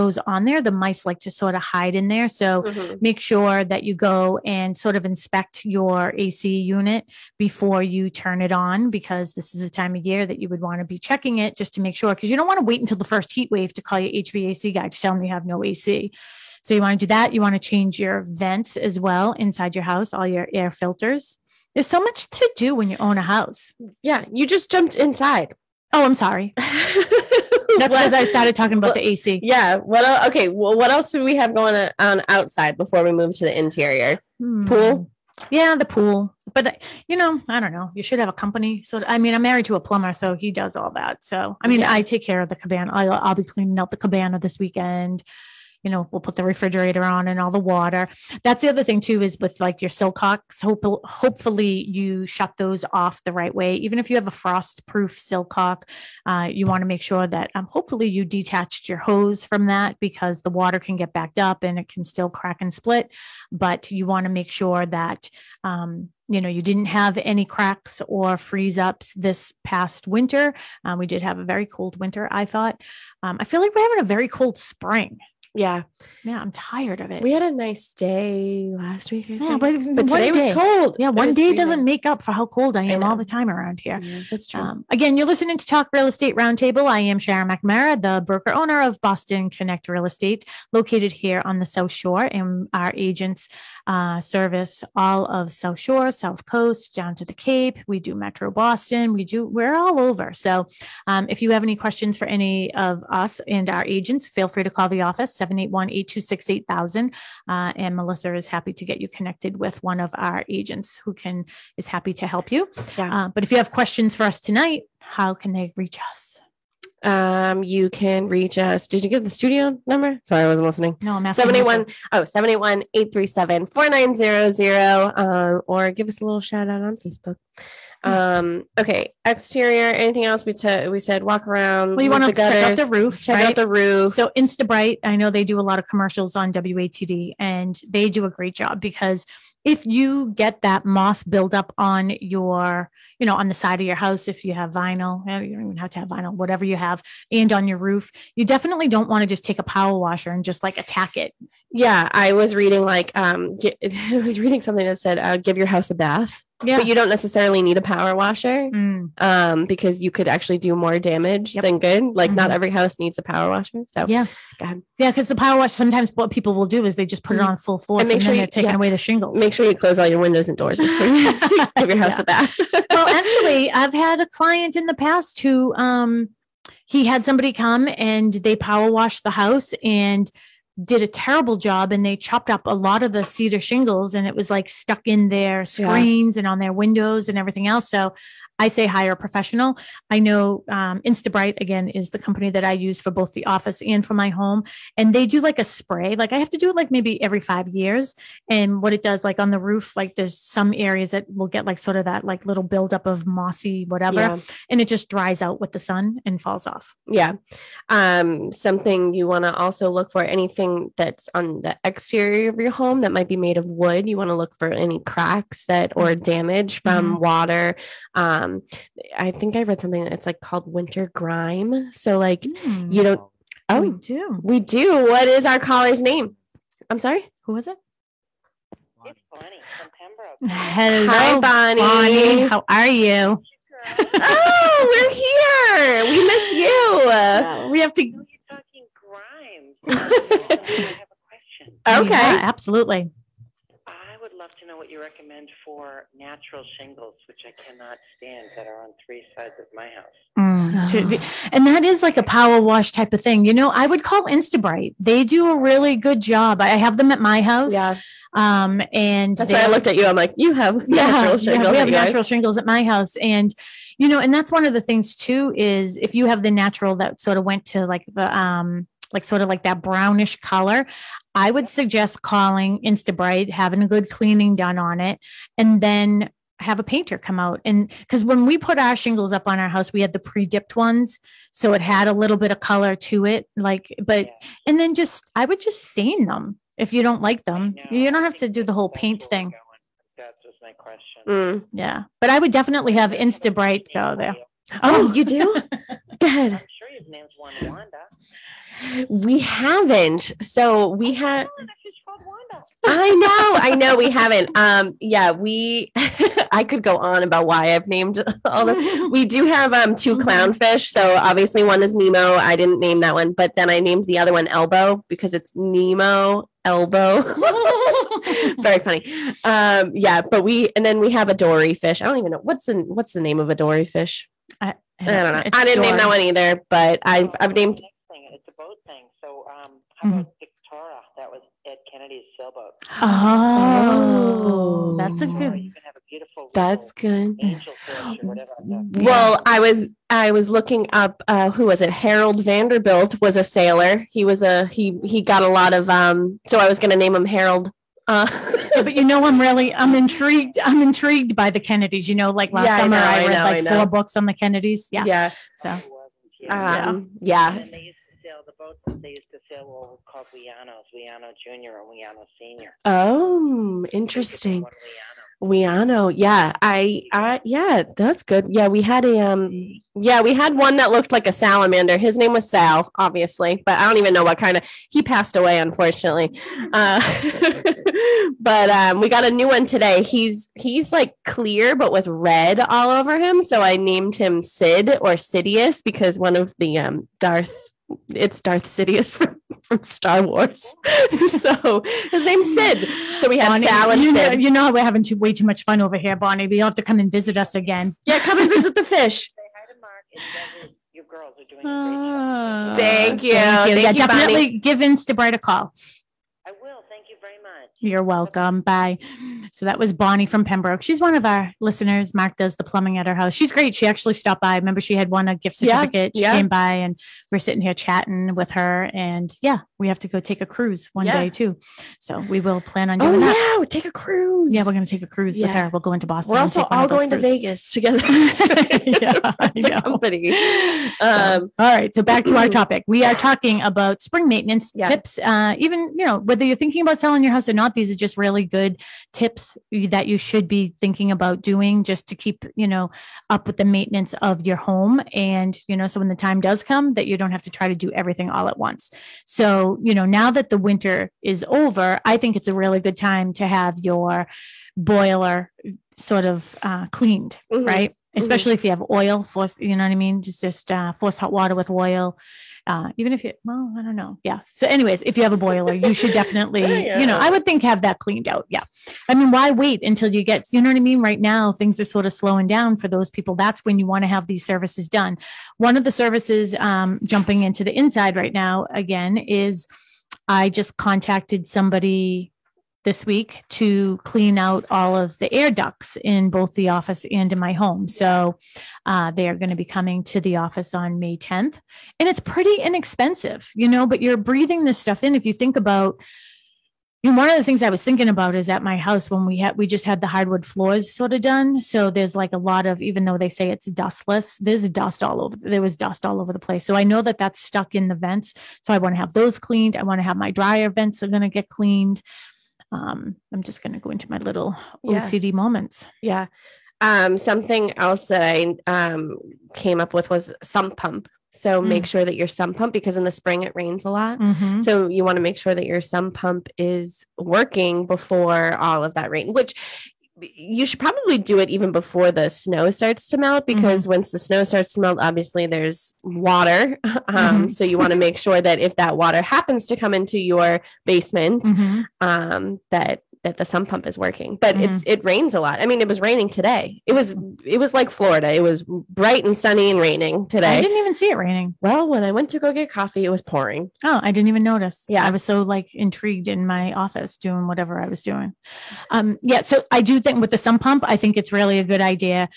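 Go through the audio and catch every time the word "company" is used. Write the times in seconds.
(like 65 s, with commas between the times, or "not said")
38 s, 192 s, 429 s.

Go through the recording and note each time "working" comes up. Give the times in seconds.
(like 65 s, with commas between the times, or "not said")
527 s, 543 s.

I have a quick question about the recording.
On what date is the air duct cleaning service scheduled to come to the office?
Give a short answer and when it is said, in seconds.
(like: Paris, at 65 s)
May 10, at 490 s.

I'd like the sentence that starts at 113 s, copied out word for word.
uh, but if you have questions for us tonight how can they reach us um, you can reach us.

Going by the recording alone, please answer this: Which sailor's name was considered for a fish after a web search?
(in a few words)
Harold Vanderbilt.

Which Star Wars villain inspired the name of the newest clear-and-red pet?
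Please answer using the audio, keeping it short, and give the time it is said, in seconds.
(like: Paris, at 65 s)
Darth Sidious, at 388 s.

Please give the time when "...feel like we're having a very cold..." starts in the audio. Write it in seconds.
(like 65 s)
73 s.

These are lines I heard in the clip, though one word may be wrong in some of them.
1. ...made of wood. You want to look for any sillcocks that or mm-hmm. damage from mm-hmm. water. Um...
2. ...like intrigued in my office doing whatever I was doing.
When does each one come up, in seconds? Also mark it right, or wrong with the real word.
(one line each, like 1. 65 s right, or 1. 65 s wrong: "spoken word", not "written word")
1. 213 s wrong: "cracks", not "sillcocks"
2. 555 s right.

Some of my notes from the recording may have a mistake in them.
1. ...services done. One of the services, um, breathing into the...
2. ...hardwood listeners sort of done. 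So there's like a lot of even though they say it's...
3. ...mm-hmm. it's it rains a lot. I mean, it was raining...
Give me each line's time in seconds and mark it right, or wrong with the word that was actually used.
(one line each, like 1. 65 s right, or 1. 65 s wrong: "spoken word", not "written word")
1. 474 s wrong: "jumping", not "breathing"
2. 500 s wrong: "floors", not "listeners"
3. 544 s right.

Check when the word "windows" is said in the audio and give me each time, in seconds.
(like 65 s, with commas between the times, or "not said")
170 s, 186 s.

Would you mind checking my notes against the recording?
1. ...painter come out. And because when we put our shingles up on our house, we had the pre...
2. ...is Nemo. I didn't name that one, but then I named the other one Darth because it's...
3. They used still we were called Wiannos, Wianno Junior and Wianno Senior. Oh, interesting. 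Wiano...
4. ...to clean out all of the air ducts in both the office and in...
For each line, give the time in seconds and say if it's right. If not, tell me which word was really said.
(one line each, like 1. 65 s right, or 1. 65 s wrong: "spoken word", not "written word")
1. 276 s right
2. 311 s wrong: "Elbow", not "Darth"
3. 359 s right
4. 483 s right.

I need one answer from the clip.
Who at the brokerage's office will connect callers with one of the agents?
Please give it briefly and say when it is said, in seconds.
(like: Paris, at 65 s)
Melissa, at 107 s.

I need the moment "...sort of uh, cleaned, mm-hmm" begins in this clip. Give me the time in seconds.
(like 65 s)
455 s.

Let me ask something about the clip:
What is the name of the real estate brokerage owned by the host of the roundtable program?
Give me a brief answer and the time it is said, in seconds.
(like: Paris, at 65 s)
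Boston Connect Real Estate, at 89 s.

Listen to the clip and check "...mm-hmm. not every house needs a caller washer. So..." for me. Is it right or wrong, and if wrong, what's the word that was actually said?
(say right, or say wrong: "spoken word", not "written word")
wrong: "power", not "caller".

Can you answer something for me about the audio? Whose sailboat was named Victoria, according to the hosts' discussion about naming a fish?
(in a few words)
Ed Kennedy.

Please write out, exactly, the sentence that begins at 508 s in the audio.
So I want to have those cleaned.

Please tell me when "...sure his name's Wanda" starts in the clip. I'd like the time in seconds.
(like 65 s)
296 s.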